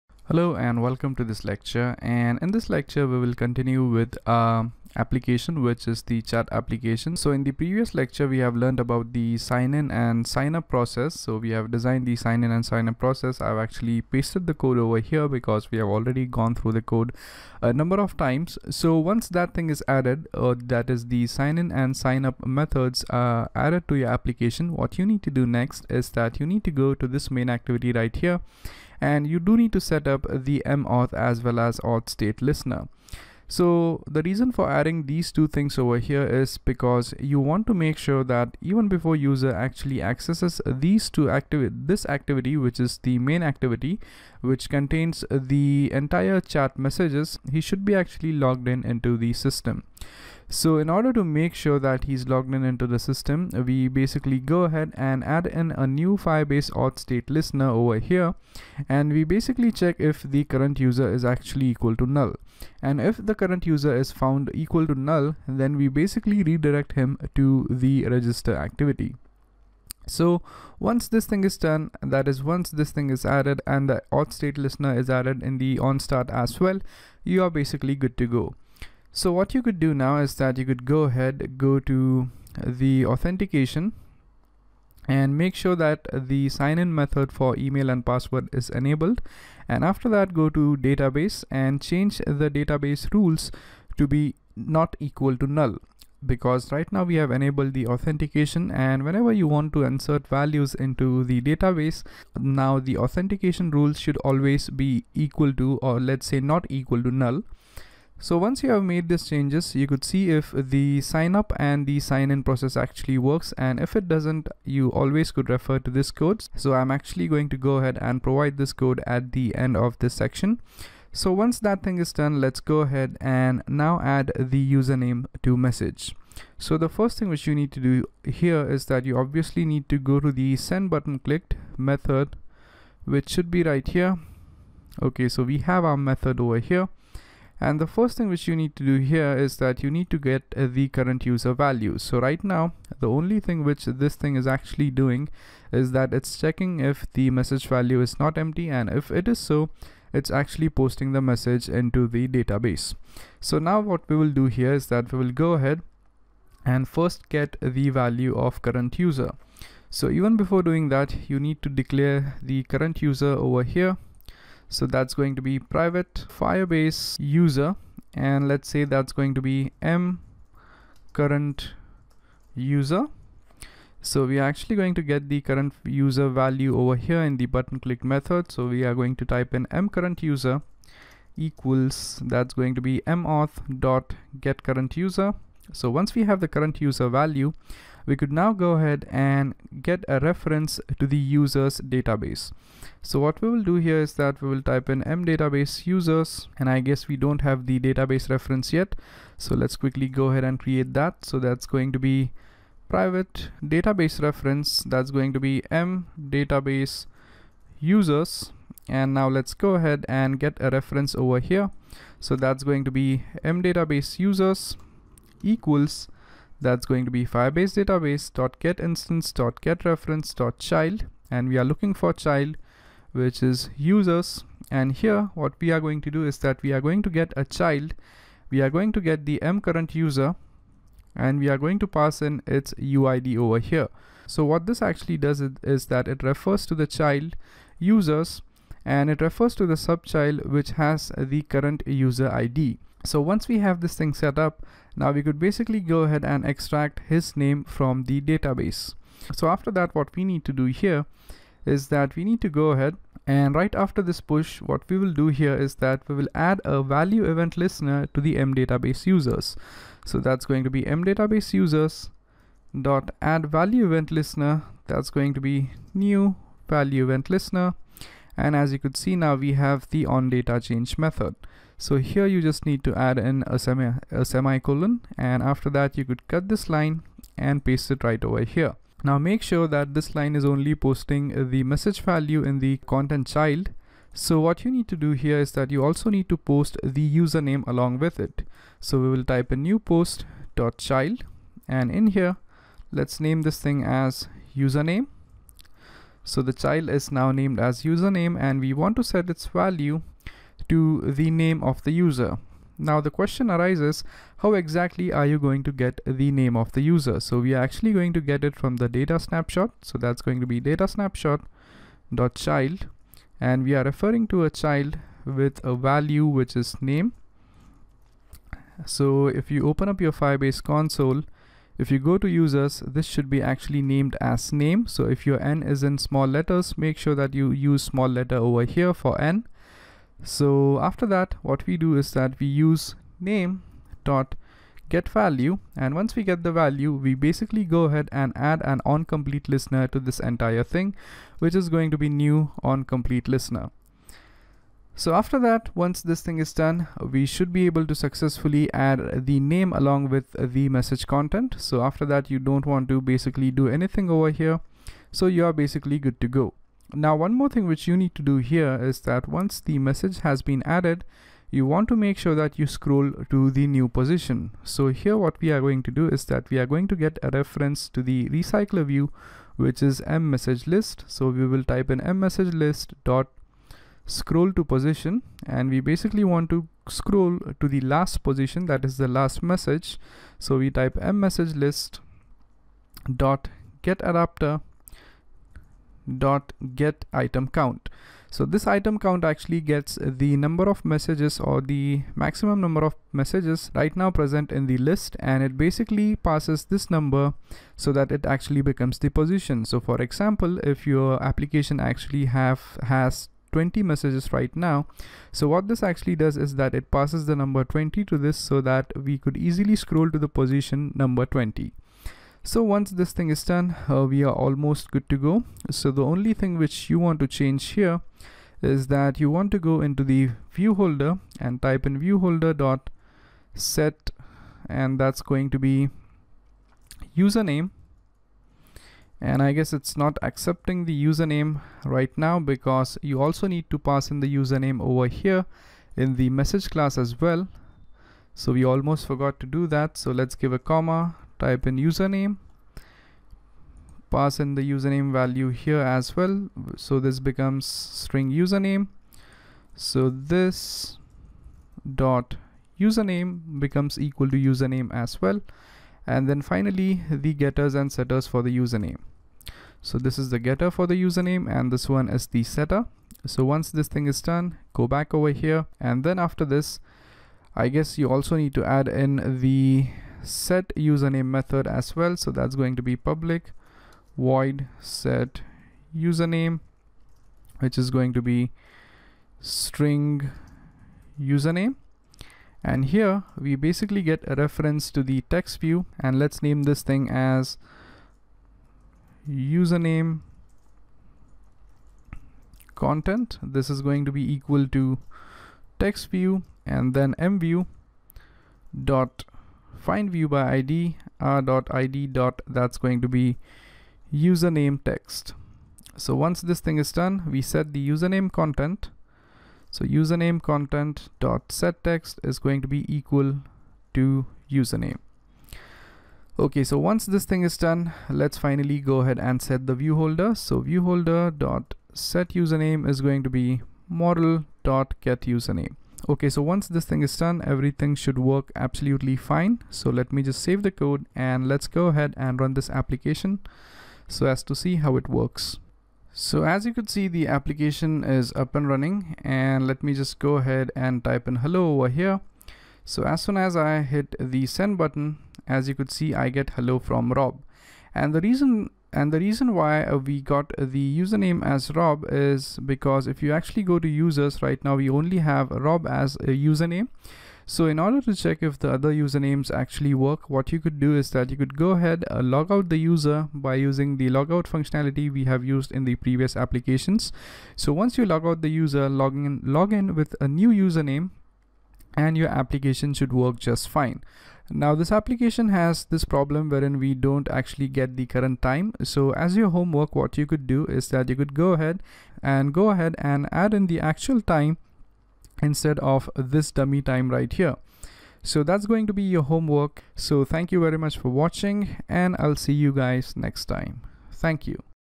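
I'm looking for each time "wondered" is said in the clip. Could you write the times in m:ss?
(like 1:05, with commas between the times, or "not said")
not said.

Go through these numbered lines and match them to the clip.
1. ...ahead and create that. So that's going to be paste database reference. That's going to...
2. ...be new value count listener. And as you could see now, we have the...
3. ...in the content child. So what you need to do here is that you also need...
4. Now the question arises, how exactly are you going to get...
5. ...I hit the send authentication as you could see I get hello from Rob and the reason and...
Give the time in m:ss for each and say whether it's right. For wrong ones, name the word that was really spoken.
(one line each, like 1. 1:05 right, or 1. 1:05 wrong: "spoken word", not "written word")
1. 3:20 wrong: "private", not "paste"
2. 4:25 wrong: "event", not "count"
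3. 4:42 right
4. 5:02 right
5. 9:03 wrong: "button", not "authentication".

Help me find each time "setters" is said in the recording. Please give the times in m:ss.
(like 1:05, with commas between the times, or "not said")
7:37, 7:42.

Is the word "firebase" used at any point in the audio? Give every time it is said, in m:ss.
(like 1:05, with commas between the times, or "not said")
0:56, 2:46, 3:37, 5:20.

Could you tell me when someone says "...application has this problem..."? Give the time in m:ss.
9:34.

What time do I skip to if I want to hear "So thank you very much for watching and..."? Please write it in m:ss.
9:49.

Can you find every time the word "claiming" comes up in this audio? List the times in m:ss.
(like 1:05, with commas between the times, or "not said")
not said.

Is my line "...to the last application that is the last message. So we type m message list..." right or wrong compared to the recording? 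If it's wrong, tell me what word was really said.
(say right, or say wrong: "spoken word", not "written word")
wrong: "position", not "application".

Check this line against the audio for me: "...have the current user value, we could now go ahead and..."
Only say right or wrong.
right.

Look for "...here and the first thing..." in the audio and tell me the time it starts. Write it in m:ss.
2:16.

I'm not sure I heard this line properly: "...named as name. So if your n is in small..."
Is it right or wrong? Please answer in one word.
right.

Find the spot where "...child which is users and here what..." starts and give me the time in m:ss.
3:42.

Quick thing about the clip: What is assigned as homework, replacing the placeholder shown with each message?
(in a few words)
actual time.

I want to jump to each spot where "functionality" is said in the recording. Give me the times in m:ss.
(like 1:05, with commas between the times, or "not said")
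9:24.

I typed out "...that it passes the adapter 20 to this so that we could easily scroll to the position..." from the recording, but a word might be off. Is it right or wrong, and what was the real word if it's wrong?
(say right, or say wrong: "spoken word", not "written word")
wrong: "number", not "adapter".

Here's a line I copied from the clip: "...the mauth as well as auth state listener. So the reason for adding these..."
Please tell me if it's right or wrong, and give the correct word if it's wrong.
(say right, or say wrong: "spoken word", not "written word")
right.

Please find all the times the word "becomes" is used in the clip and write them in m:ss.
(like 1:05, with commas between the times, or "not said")
6:38, 7:27, 7:33.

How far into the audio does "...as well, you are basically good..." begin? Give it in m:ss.
1:16.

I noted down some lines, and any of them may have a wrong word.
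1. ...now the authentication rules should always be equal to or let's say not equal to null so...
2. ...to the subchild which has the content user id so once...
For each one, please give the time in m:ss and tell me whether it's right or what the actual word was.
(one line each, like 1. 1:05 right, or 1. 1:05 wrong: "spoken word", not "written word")
1. 1:42 right
2. 3:59 wrong: "current", not "content".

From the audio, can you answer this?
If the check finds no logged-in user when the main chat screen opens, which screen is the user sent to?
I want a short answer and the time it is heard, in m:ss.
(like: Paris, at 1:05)
register activity, at 1:08.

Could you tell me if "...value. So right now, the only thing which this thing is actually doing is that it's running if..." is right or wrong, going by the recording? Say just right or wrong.
wrong.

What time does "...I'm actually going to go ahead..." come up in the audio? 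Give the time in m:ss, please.
1:56.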